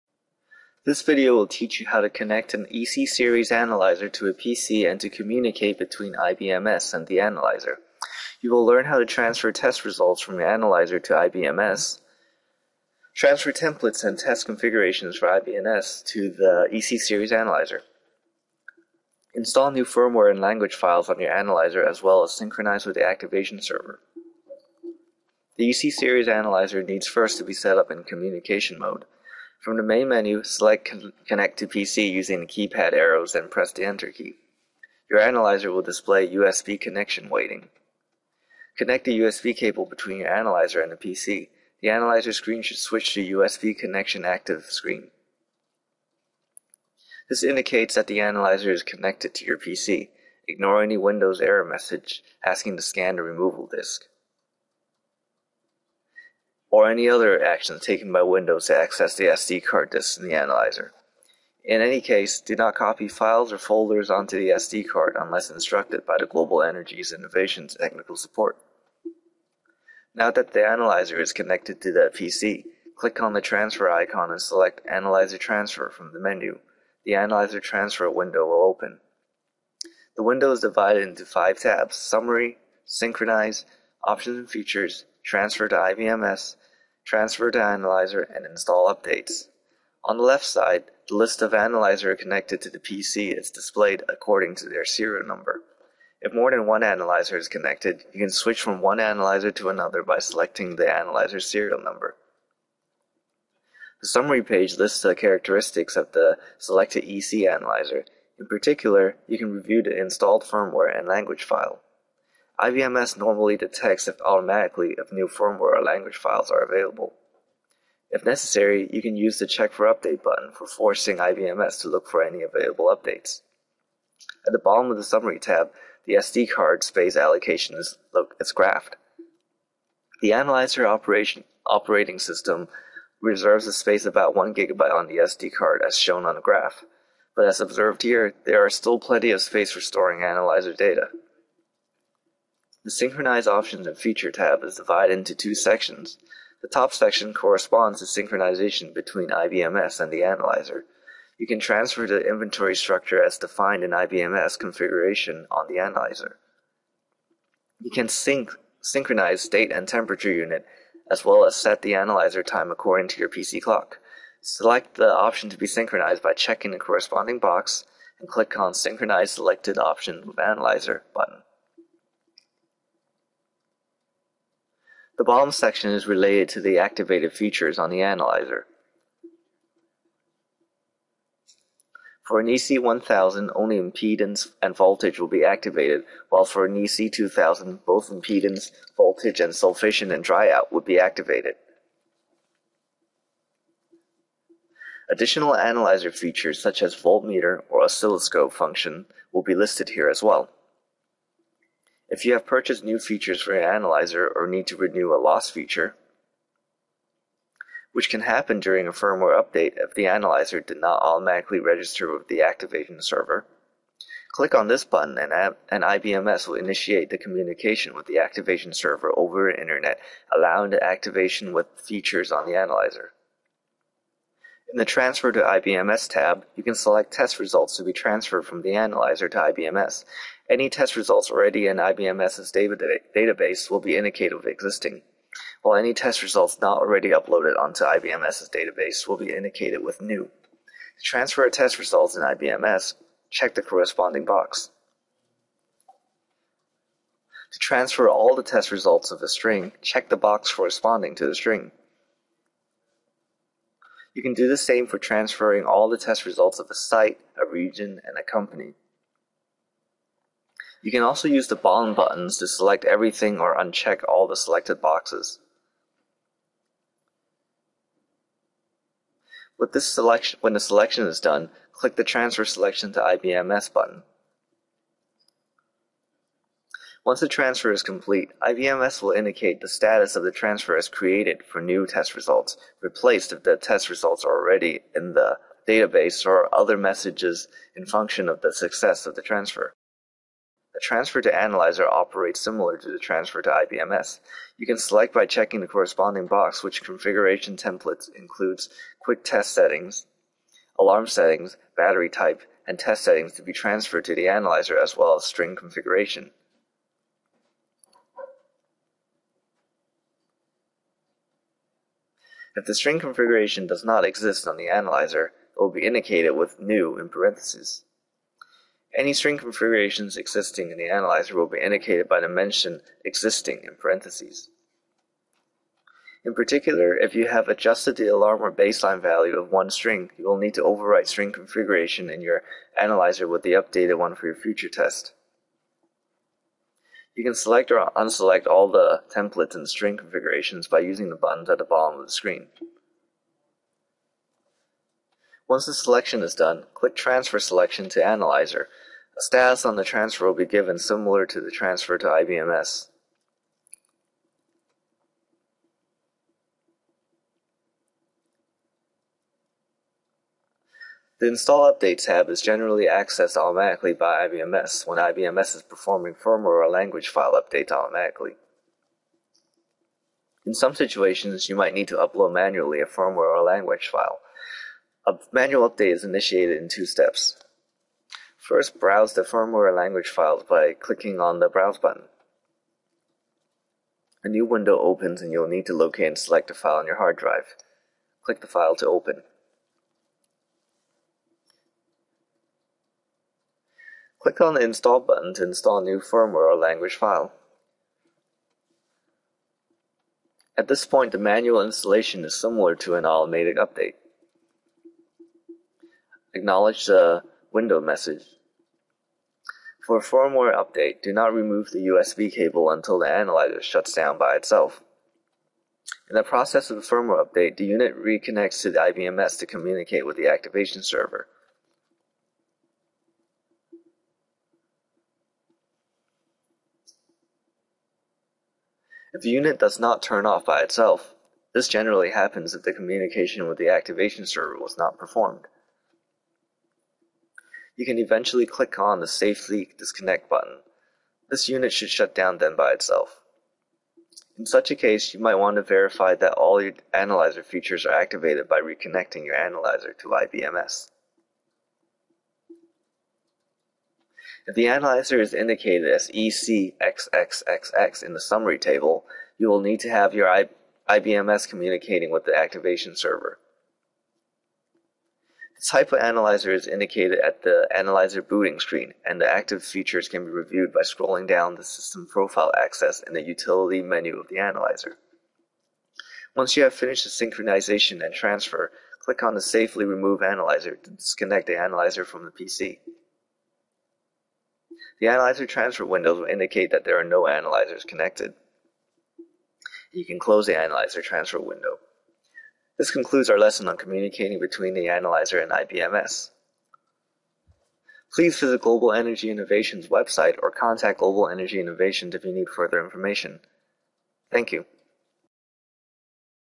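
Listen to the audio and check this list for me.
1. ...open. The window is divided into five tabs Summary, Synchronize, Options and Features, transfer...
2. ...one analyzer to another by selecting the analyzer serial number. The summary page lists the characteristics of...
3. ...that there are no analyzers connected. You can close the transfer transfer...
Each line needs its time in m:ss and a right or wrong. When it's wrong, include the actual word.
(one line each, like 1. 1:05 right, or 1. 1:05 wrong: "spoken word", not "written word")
1. 1:18 right
2. 1:38 right
3. 8:06 wrong: "analyzer", not "transfer".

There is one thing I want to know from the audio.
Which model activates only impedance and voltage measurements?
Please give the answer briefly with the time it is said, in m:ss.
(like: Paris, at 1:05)
EC1000, at 3:02.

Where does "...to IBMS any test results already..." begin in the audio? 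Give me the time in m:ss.
3:49.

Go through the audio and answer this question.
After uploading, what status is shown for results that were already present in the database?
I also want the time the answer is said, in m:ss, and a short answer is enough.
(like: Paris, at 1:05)
replaced, at 4:42.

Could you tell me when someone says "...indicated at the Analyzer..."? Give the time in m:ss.
7:46.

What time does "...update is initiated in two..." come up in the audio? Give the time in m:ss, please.
6:15.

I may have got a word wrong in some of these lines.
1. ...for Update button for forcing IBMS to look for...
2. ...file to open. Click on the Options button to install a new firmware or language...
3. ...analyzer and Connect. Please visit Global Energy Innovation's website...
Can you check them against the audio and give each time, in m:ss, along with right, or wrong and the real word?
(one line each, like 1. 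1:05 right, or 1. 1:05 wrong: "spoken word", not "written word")
1. 1:59 right
2. 6:28 wrong: "Install", not "Options"
3. 8:14 wrong: "IBMS", not "Connect".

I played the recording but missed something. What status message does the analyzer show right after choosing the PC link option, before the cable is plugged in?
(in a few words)
USB connection waiting.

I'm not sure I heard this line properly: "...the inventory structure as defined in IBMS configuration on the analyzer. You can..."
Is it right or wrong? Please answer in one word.
right.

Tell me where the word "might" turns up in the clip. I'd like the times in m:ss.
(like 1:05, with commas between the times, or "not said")
6:11, 7:25.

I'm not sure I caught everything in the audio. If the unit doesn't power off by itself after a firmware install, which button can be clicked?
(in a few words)
safely disconnect.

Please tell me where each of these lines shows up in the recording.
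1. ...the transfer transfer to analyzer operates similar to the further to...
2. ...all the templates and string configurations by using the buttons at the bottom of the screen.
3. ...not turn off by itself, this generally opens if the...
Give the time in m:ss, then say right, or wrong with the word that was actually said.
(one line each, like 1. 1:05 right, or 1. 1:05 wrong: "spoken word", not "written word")
1. 4:49 wrong: "transfer", not "further"
2. 5:38 right
3. 7:09 wrong: "happens", not "opens".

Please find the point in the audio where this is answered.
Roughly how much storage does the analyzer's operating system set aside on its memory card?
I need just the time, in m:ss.
2:14.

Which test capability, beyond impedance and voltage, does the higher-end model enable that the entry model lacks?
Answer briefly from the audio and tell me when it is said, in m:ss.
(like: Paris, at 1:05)
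sulfation and dryout, at 3:09.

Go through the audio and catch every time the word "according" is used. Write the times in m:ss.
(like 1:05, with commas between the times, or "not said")
1:34, 2:42.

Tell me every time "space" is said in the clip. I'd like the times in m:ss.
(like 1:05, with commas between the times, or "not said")
2:06, 2:13, 2:19.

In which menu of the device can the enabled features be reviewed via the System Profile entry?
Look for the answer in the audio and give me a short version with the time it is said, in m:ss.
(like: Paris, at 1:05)
Utility menu, at 7:53.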